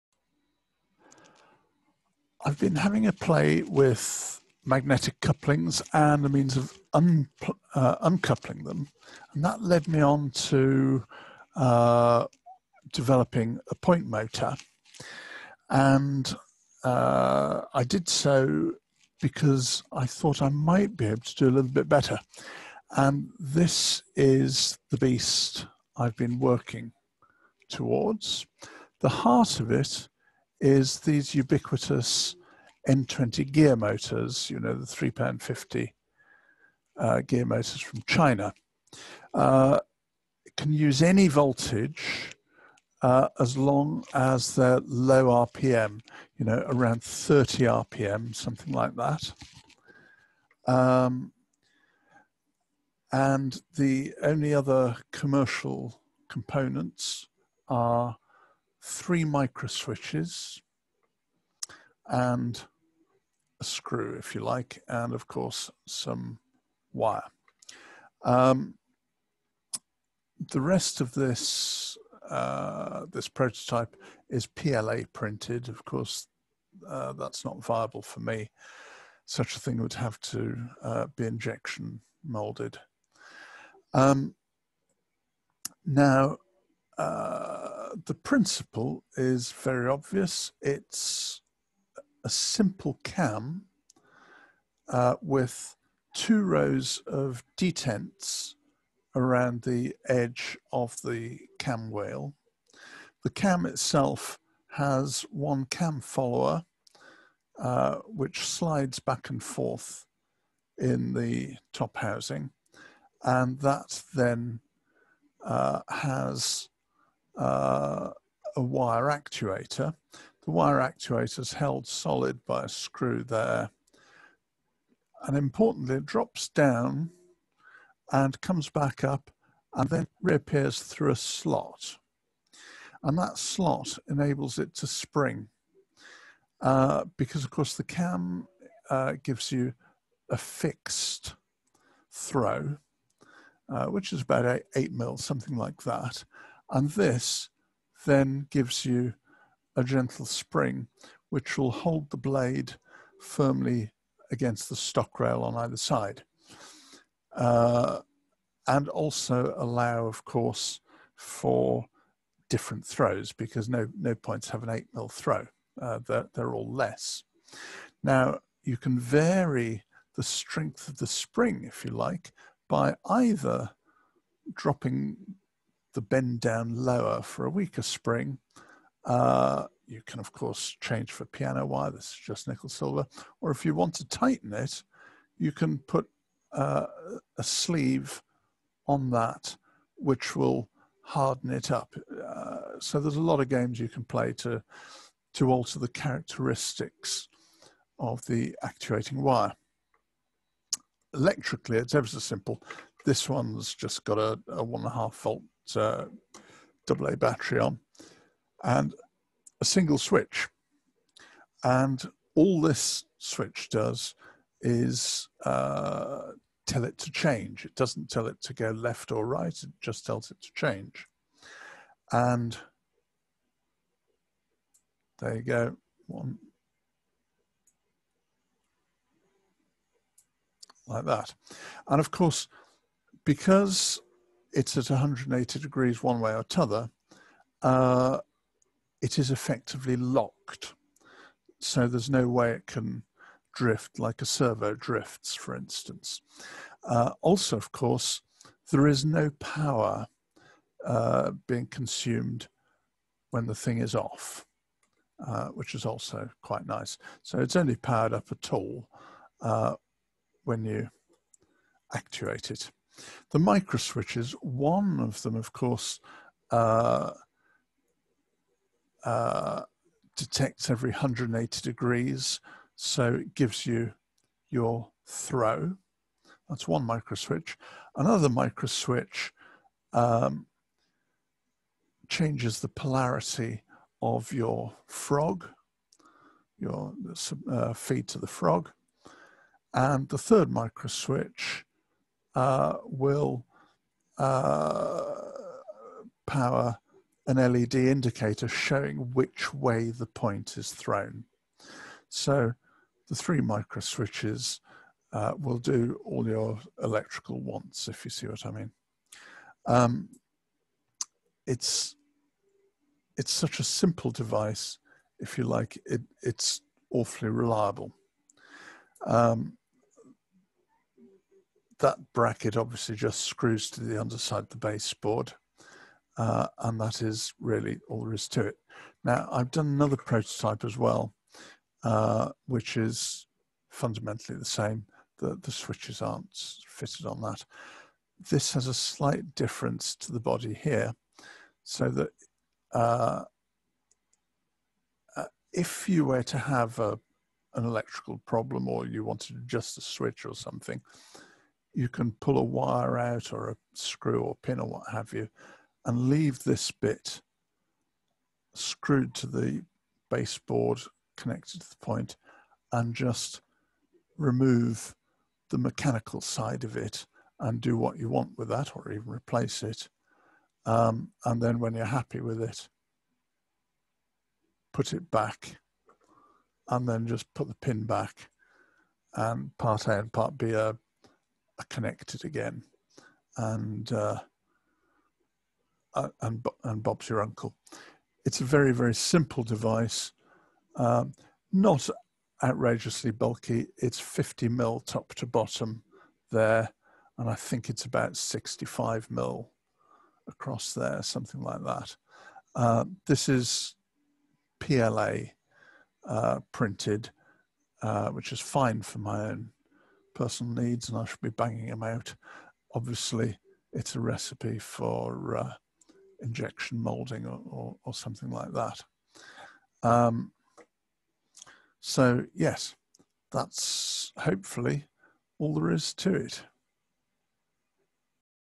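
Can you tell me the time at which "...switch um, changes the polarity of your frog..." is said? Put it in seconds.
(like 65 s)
278 s.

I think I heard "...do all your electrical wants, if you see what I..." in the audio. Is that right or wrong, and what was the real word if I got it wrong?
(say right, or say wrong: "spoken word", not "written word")
right.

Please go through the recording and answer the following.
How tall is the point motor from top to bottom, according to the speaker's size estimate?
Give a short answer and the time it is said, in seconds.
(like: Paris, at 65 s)
50 mm, at 393 s.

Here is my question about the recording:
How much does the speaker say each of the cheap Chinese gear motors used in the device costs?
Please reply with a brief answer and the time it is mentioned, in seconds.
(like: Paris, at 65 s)
£3.50, at 34 s.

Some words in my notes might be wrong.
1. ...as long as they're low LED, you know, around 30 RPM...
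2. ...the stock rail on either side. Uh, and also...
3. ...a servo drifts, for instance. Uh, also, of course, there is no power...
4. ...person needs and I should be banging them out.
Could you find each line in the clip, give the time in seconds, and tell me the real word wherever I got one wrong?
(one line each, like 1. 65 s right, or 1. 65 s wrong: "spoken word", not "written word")
1. 43 s wrong: "RPM", not "LED"
2. 154 s right
3. 244 s right
4. 410 s right.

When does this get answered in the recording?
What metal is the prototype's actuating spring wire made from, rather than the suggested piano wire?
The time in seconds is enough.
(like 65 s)
182 s.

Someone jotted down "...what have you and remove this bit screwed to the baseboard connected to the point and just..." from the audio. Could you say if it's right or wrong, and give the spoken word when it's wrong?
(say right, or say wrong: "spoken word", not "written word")
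wrong: "leave", not "remove".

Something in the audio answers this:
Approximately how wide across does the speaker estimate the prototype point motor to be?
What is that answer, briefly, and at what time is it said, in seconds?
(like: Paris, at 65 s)
65 mm, at 398 s.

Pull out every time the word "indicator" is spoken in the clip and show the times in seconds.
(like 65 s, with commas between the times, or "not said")
297 s.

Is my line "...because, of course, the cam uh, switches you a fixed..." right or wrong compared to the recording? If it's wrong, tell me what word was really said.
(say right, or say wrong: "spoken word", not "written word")
wrong: "gives", not "switches".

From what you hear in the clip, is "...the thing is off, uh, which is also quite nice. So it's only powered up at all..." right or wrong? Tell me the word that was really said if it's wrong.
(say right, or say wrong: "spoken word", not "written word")
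right.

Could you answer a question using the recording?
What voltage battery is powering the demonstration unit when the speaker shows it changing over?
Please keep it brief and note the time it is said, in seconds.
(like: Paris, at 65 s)
1.5 volts, at 204 s.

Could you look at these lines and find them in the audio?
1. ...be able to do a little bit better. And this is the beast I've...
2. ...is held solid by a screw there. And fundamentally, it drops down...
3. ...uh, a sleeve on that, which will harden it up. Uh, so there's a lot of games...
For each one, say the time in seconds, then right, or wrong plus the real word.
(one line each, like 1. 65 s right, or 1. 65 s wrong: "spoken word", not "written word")
1. 20 s right
2. 121 s wrong: "importantly", not "fundamentally"
3. 186 s right.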